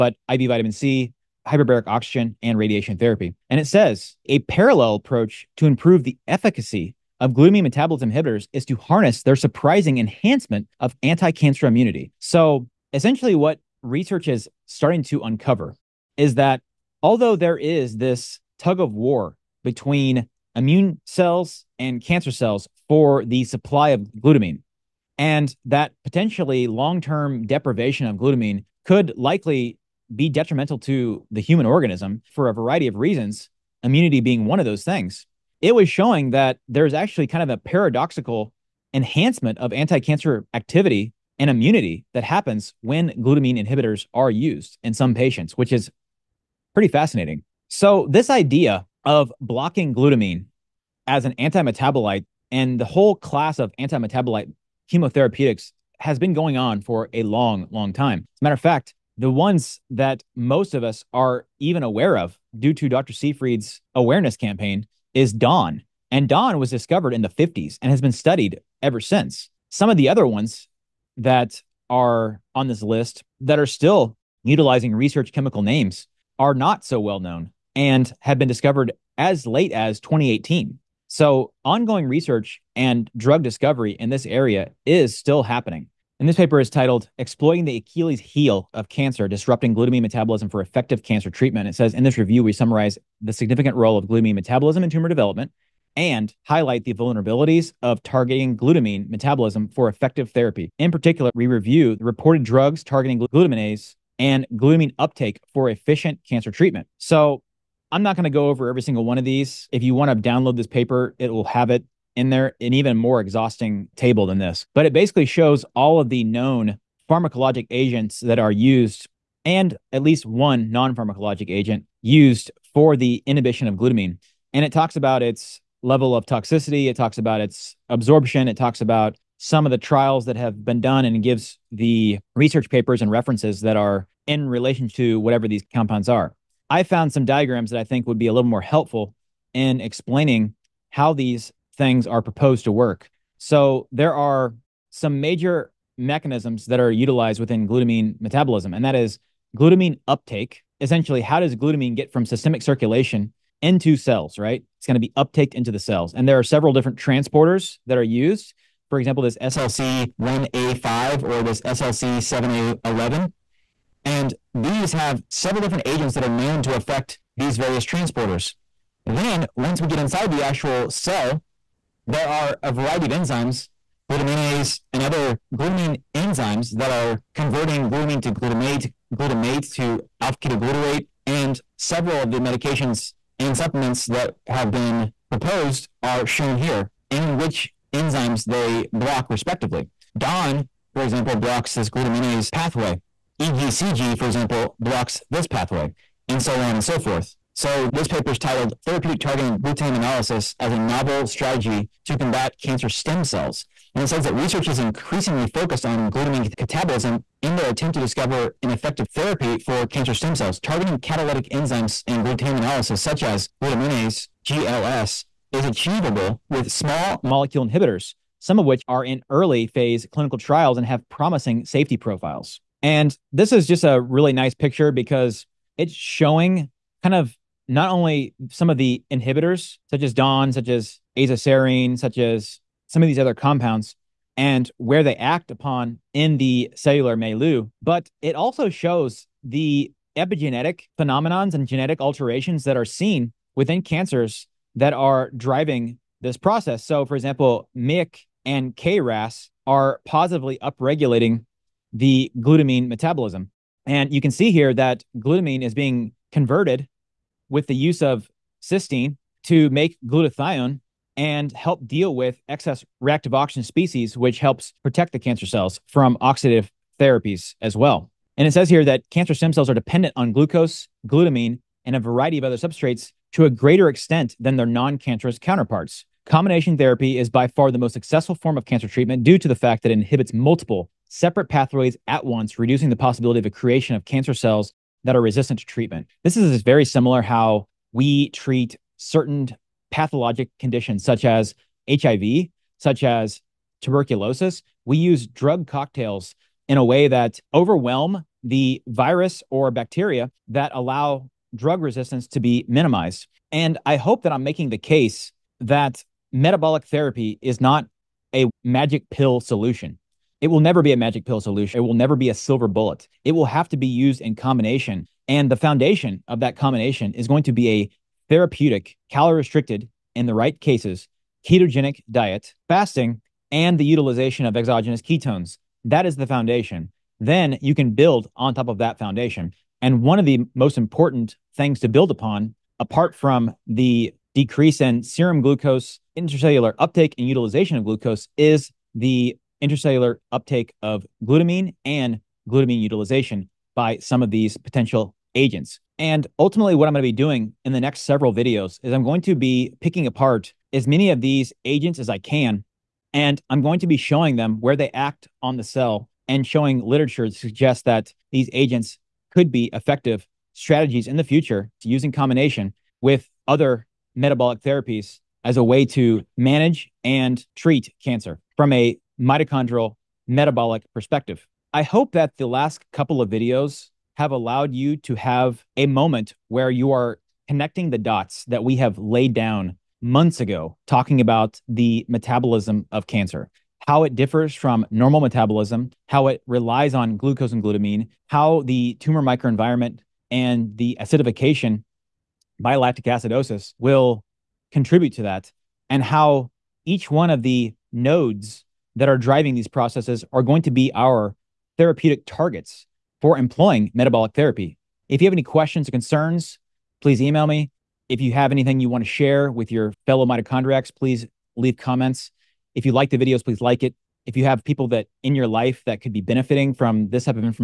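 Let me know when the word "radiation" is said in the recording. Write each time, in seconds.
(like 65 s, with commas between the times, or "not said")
2 s.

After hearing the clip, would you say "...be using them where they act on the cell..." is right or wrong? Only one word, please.
wrong.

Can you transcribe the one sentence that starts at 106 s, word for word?
So I'm not going to go over every single one of these.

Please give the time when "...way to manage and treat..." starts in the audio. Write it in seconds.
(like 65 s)
365 s.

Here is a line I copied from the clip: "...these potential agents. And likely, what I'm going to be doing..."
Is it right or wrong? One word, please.
wrong.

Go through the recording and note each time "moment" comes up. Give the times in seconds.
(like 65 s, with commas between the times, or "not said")
375 s.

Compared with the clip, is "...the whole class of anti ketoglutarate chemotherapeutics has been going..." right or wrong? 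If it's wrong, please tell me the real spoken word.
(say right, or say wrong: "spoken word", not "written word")
wrong: "metabolite", not "ketoglutarate".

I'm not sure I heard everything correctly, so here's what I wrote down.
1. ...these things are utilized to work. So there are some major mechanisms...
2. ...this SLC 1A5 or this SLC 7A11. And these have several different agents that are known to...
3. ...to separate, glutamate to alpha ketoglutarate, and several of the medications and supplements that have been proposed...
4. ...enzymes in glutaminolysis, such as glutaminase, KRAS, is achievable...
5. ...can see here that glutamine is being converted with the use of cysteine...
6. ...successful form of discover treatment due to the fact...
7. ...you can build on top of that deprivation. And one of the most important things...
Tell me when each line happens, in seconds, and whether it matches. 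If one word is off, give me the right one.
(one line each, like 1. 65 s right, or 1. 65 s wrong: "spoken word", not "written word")
1. 141 s wrong: "proposed", not "utilized"
2. 159 s right
3. 178 s wrong: "glutamate", not "separate"
4. 211 s wrong: "GLS", not "KRAS"
5. 254 s right
6. 277 s wrong: "cancer", not "discover"
7. 327 s wrong: "foundation", not "deprivation".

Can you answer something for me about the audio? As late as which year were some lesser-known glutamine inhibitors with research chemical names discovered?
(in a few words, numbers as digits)
2018.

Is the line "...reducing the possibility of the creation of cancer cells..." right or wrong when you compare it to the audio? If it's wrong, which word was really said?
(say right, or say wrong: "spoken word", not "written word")
right.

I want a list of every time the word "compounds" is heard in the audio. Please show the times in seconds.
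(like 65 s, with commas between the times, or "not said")
135 s, 233 s.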